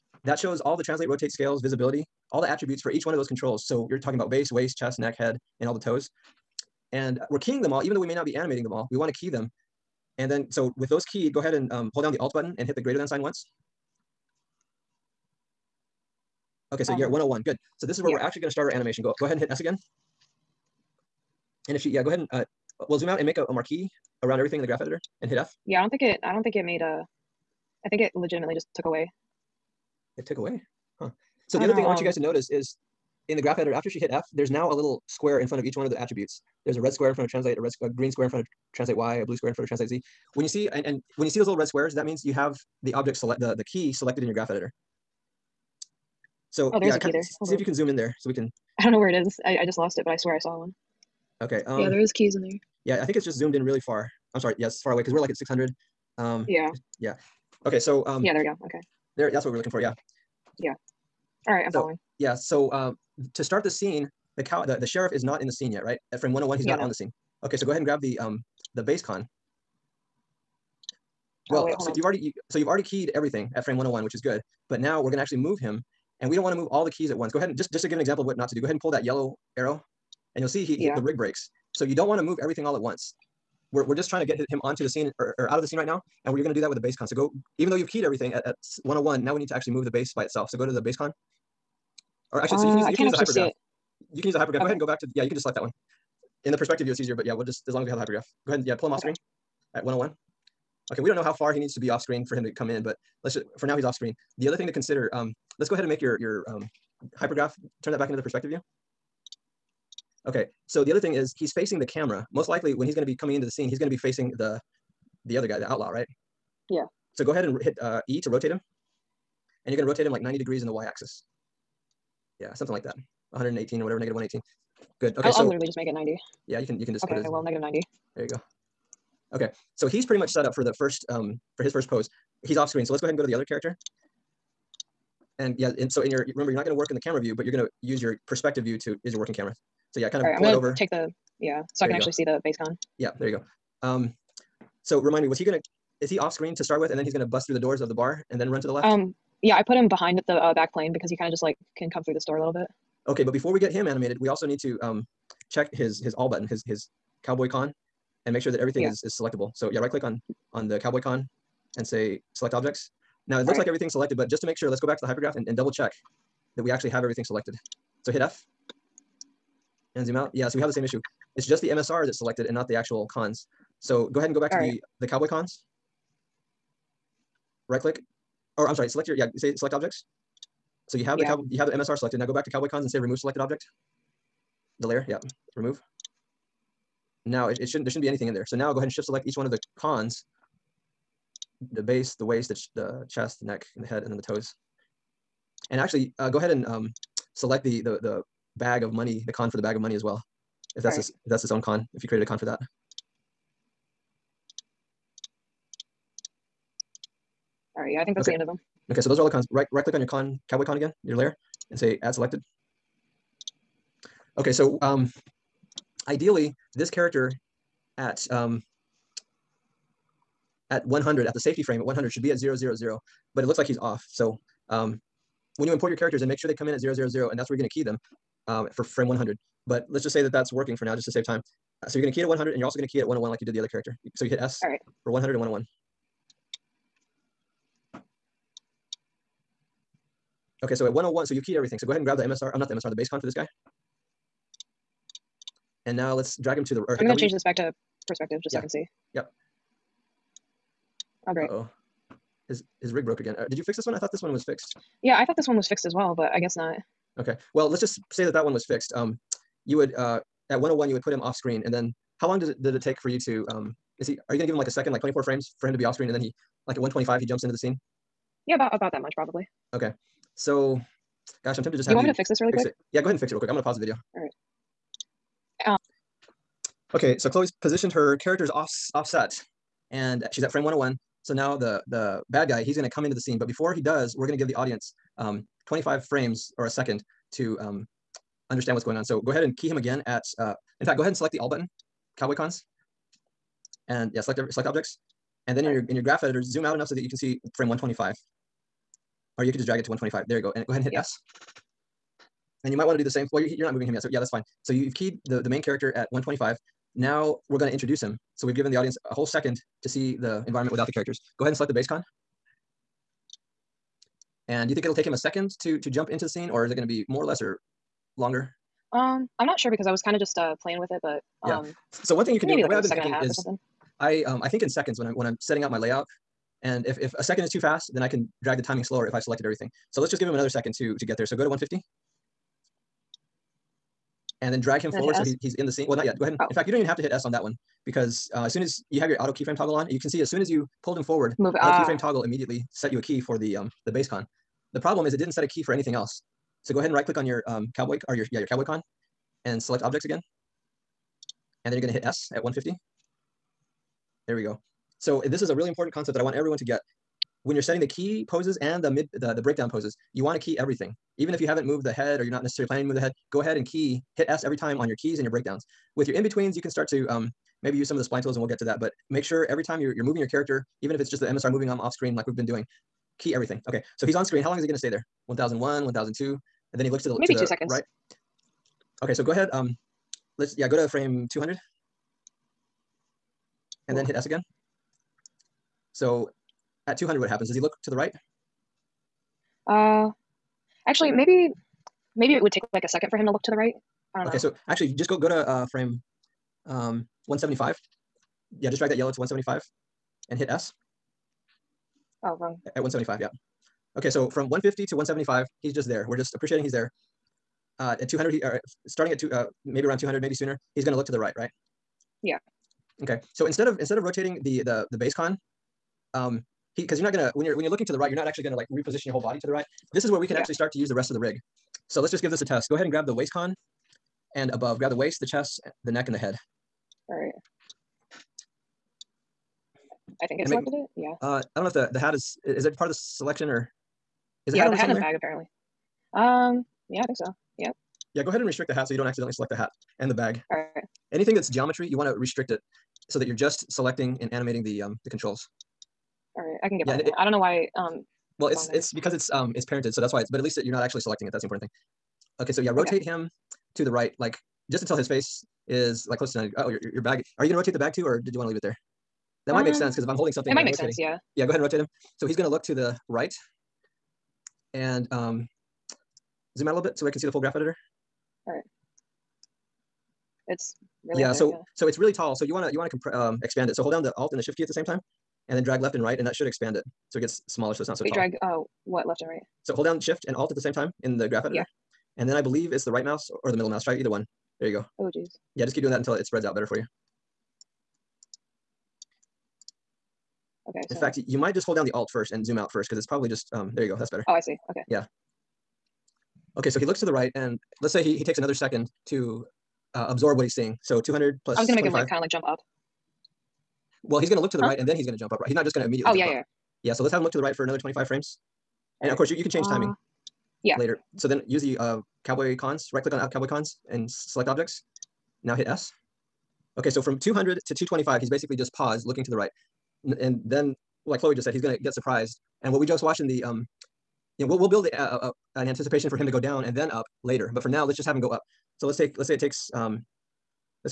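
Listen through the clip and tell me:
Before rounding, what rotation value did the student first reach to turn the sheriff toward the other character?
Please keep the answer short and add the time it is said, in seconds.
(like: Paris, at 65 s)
-118, at 123 s.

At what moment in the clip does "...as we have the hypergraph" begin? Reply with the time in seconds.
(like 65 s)
97 s.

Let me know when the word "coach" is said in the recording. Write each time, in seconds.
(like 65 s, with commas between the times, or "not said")
not said.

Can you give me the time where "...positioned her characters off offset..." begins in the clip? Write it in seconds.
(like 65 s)
277 s.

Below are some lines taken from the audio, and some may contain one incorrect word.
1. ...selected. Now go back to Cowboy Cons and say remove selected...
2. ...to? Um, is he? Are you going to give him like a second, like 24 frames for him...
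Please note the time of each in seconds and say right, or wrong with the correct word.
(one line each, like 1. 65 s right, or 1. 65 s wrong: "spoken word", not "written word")
1. 181 s right
2. 263 s right.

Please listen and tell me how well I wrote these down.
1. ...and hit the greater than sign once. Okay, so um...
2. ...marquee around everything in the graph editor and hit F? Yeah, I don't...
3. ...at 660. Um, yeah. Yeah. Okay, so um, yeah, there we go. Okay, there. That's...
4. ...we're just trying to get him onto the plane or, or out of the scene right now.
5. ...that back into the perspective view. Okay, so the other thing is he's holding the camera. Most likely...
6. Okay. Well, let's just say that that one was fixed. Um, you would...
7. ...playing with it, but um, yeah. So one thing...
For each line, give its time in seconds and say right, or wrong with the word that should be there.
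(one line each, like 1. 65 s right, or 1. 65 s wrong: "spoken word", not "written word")
1. 12 s right
2. 23 s right
3. 55 s wrong: "600", not "660"
4. 83 s wrong: "scene", not "plane"
5. 107 s wrong: "facing", not "holding"
6. 257 s right
7. 320 s right.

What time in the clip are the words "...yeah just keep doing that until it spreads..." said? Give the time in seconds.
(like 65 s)
485 s.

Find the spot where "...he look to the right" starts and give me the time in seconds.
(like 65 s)
387 s.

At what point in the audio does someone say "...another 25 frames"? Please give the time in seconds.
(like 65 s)
507 s.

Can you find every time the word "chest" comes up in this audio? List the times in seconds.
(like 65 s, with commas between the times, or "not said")
4 s, 193 s, 425 s.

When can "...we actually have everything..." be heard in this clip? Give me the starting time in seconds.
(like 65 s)
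166 s.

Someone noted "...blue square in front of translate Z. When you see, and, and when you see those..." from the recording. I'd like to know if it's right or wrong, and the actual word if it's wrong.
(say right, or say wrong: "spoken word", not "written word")
right.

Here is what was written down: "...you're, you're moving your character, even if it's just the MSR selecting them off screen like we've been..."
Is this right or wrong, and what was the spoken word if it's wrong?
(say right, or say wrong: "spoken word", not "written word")
wrong: "moving", not "selecting".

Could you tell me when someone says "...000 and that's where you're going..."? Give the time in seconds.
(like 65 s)
226 s.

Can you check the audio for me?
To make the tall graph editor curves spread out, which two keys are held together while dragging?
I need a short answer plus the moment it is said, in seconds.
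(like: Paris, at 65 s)
shift and alt, at 479 s.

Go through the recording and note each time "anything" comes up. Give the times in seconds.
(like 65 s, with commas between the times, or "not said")
188 s, 345 s, 441 s.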